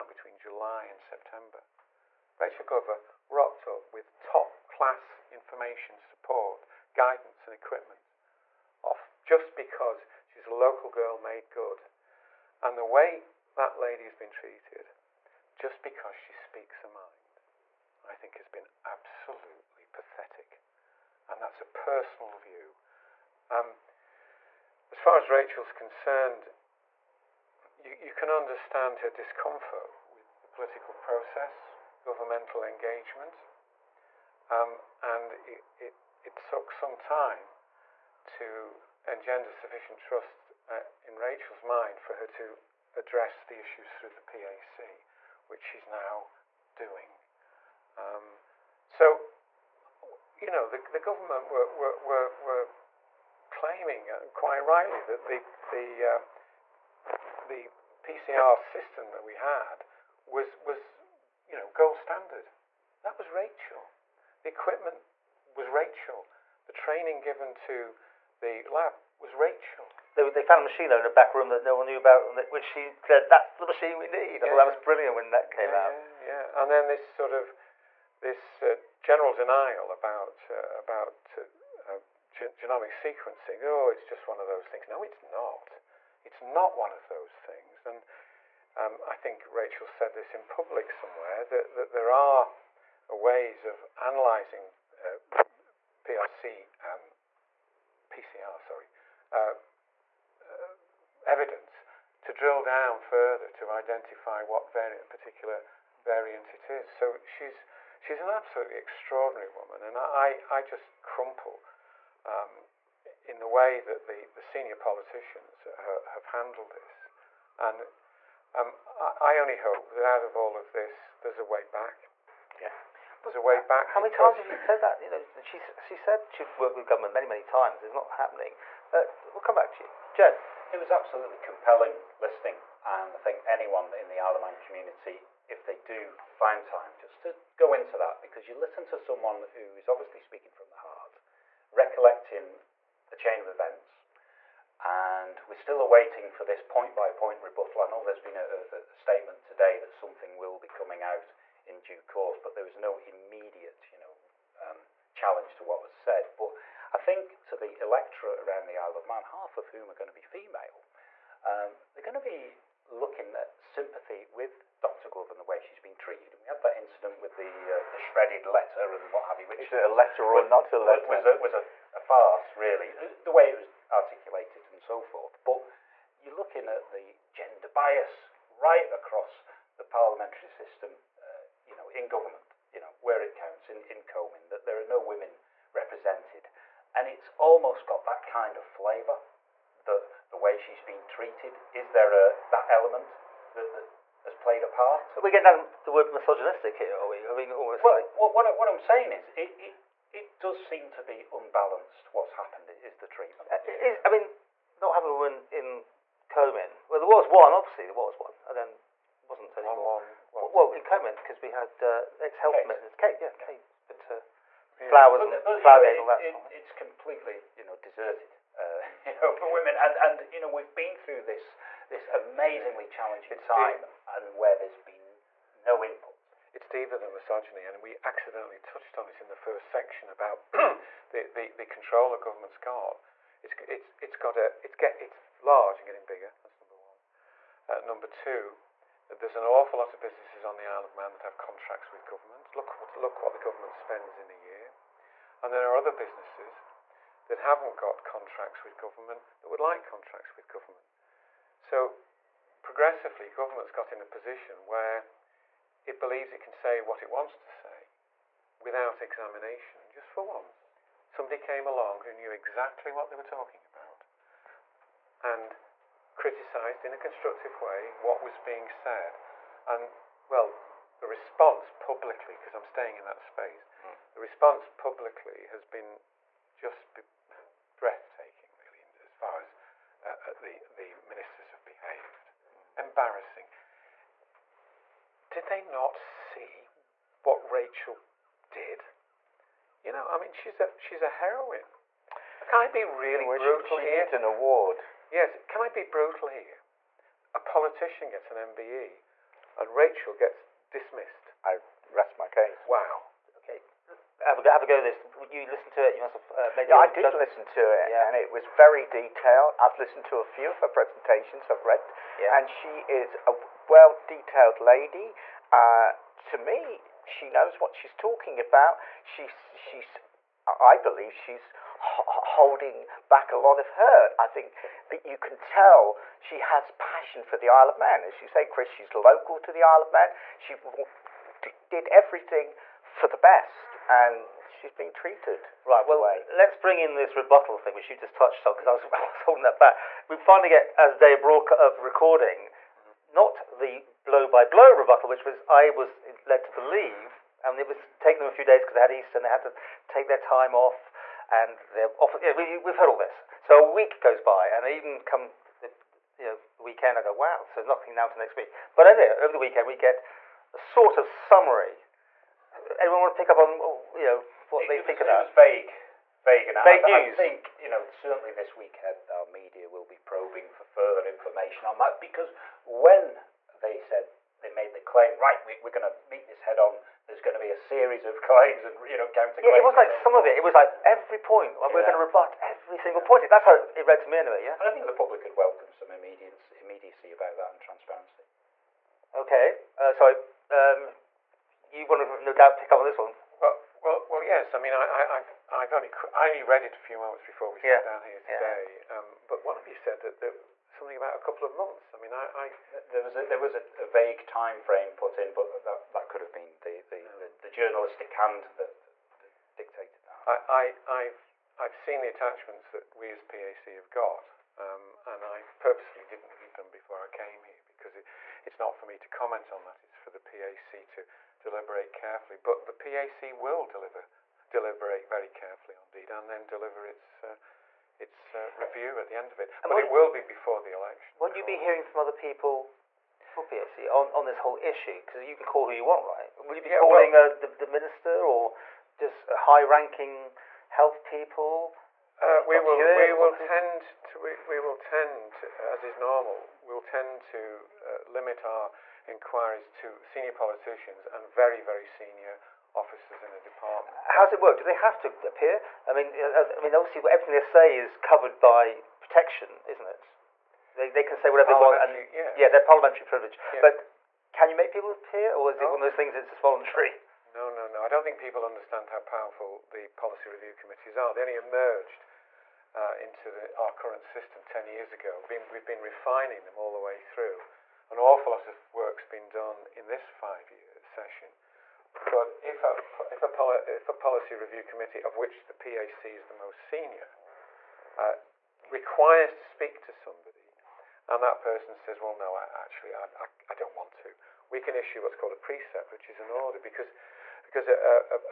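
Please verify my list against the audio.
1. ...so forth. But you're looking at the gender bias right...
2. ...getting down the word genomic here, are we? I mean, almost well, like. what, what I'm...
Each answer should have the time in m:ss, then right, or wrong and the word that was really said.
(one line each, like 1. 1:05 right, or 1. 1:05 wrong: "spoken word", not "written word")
1. 2:54 right
2. 3:15 wrong: "misogynistic", not "genomic".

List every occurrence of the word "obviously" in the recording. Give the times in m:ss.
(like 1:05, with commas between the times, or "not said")
2:19, 3:27, 7:36.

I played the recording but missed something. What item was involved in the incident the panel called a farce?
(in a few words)
Shredded letter.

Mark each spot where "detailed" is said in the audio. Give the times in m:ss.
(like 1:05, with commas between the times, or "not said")
5:08, 5:14.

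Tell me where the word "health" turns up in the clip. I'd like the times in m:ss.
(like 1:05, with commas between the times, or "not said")
3:32, 7:20.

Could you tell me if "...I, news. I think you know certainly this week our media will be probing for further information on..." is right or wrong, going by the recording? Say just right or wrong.
right.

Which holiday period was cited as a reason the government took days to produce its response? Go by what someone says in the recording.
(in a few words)
Easter.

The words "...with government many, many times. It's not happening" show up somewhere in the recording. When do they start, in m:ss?
2:06.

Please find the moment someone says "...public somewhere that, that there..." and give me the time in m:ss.
1:30.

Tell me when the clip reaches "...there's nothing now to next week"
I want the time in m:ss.
5:57.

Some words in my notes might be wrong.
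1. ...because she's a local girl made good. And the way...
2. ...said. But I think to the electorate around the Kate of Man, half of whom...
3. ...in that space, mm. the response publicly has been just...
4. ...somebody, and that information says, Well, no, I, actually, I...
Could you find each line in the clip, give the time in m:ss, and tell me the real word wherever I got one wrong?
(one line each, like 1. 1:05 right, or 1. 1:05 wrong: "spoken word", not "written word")
1. 0:09 right
2. 2:35 wrong: "Isle", not "Kate"
3. 4:32 right
4. 8:09 wrong: "person", not "information".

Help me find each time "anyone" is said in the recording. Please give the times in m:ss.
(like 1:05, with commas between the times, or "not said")
2:13, 6:02.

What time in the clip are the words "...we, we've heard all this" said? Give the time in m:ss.
5:52.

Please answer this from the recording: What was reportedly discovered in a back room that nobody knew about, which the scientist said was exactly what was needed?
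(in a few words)
A machine.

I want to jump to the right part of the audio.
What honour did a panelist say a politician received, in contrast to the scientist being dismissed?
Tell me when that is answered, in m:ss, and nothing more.
4:58.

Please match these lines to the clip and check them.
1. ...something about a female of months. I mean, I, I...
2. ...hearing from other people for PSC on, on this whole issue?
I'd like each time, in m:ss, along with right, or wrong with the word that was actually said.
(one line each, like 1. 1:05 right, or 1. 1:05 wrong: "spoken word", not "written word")
1. 6:40 wrong: "couple", not "female"
2. 7:11 right.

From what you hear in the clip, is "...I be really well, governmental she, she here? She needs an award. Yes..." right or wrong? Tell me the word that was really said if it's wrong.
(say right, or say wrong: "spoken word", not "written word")
wrong: "brutal", not "governmental".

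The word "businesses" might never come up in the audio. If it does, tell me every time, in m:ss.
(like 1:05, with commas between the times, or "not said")
4:00, 4:05.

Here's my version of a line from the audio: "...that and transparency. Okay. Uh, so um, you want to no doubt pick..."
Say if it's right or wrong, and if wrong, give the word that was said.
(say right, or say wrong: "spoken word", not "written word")
right.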